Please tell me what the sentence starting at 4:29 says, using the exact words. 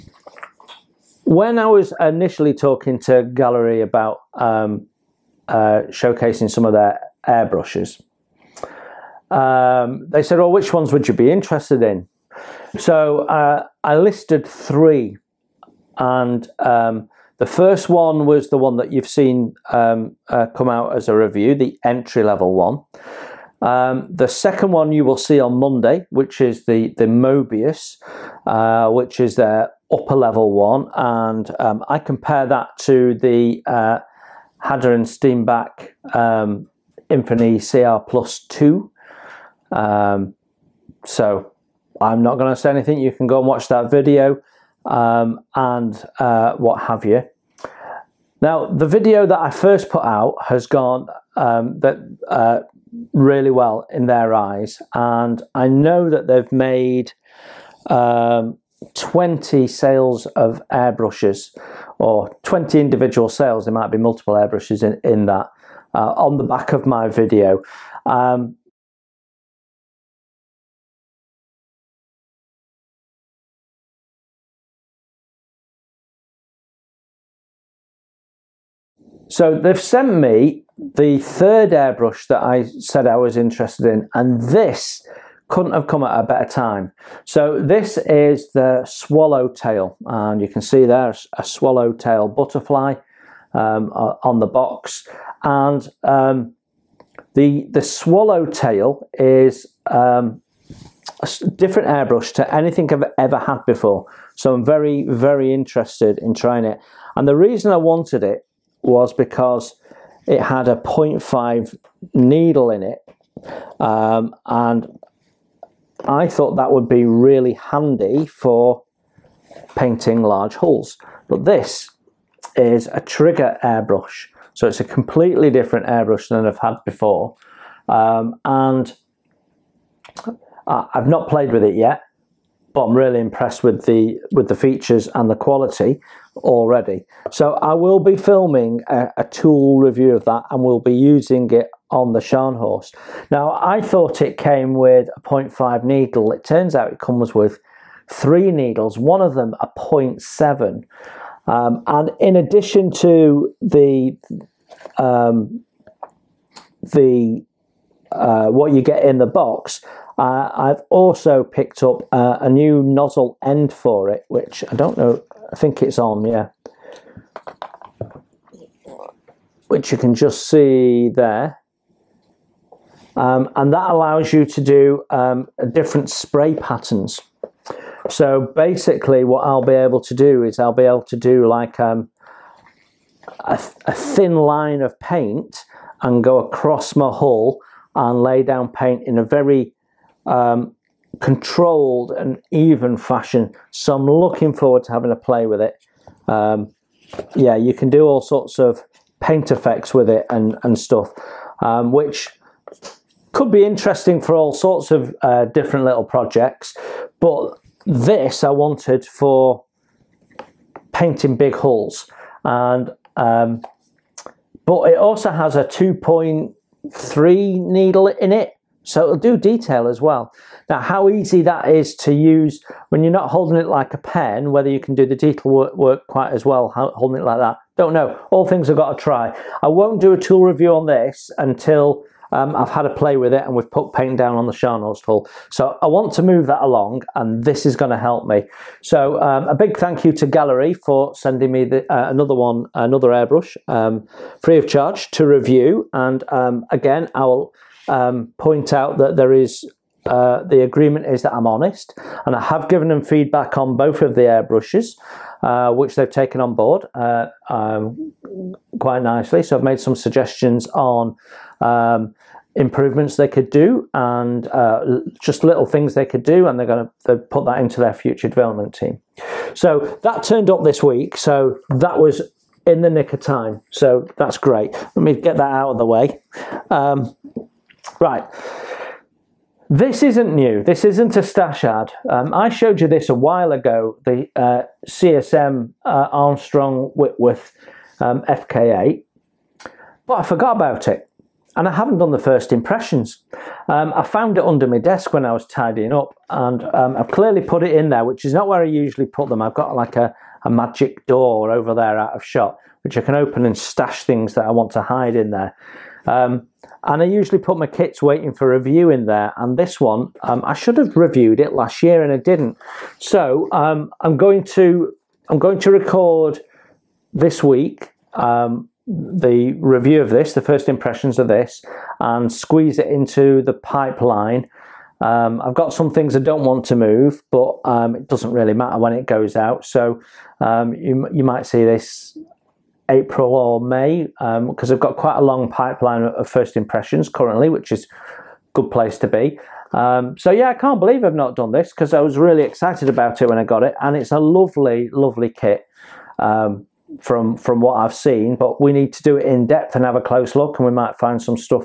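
So that turned up this week.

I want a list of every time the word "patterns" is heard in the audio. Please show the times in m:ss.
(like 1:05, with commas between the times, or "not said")
2:56.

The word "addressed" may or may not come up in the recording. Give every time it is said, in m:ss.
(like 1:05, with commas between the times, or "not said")
not said.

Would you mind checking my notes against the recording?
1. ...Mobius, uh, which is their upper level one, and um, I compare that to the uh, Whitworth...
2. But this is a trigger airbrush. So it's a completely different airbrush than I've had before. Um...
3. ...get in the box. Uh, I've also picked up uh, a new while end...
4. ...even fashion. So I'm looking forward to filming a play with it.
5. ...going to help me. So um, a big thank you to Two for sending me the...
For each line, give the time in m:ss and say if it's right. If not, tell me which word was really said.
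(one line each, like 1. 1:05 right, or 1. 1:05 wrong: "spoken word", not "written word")
1. 0:27 wrong: "Harder", not "Whitworth"
2. 2:01 right
3. 2:38 wrong: "nozzle", not "while"
4. 3:12 wrong: "having", not "filming"
5. 3:57 wrong: "Gaahleri", not "Two".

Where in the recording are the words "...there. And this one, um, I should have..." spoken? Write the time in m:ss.
5:09.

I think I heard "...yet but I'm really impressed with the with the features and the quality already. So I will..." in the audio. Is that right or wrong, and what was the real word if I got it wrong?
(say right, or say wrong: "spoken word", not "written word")
right.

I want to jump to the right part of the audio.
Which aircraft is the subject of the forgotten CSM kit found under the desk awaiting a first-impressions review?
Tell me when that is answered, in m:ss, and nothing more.
4:46.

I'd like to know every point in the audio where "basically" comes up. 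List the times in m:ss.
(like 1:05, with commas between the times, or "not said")
2:58.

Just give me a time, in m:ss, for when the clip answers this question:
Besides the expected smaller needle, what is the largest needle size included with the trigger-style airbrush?
2:29.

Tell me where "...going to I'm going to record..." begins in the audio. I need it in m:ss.
5:14.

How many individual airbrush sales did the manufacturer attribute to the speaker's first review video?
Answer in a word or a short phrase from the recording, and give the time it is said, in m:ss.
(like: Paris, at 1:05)
20, at 1:02.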